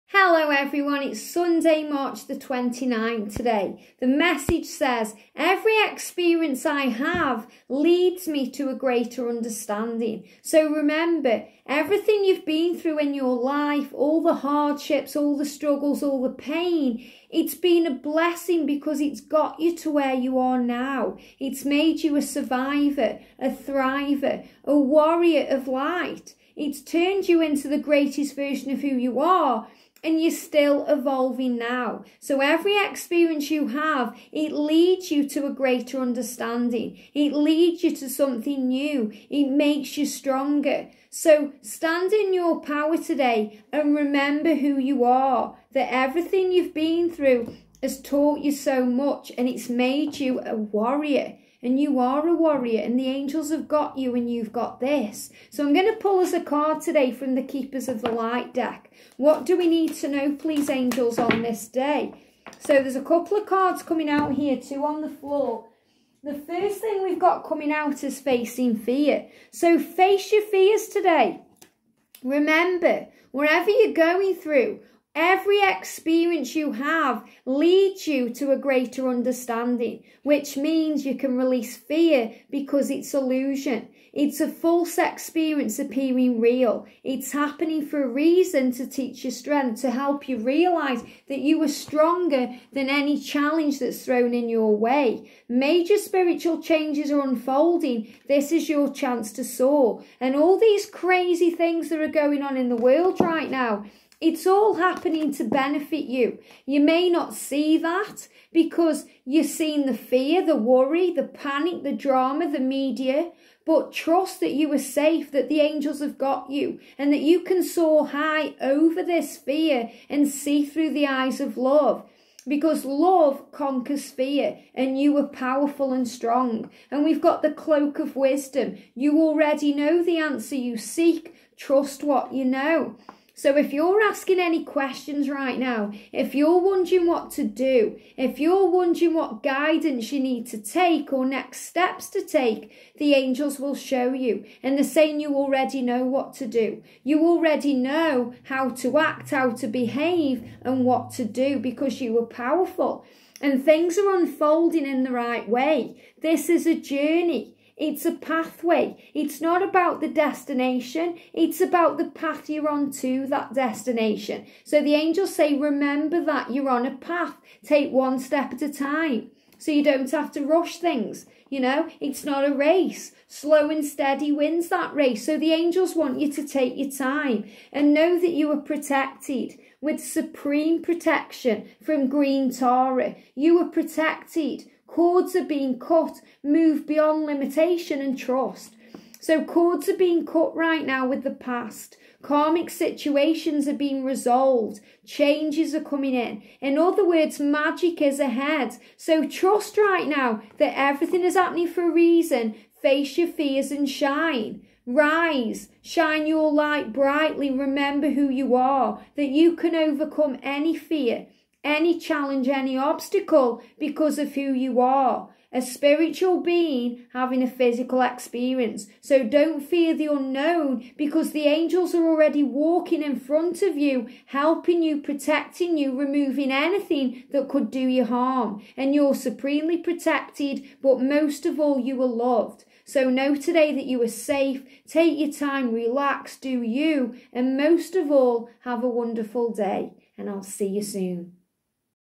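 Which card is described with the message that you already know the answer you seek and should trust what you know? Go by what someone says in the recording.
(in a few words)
Cloak of wisdom.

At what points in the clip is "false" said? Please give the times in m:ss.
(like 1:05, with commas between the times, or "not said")
1:24.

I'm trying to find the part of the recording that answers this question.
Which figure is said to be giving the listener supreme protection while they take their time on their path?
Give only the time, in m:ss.
3:02.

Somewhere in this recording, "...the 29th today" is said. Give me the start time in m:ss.
0:02.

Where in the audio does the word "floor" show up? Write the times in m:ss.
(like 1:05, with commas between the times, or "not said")
1:05.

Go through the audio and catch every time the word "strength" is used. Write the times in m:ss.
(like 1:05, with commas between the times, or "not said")
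1:29.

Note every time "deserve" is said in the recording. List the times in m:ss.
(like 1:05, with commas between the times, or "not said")
not said.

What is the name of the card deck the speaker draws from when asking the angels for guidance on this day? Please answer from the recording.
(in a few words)
Keepers of the Light.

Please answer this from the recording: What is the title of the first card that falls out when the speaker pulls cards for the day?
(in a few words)
Facing fear.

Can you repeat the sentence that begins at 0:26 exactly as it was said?
It's turned you into the greatest version of who you are and you're still evolving now.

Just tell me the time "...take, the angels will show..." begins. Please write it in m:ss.
2:22.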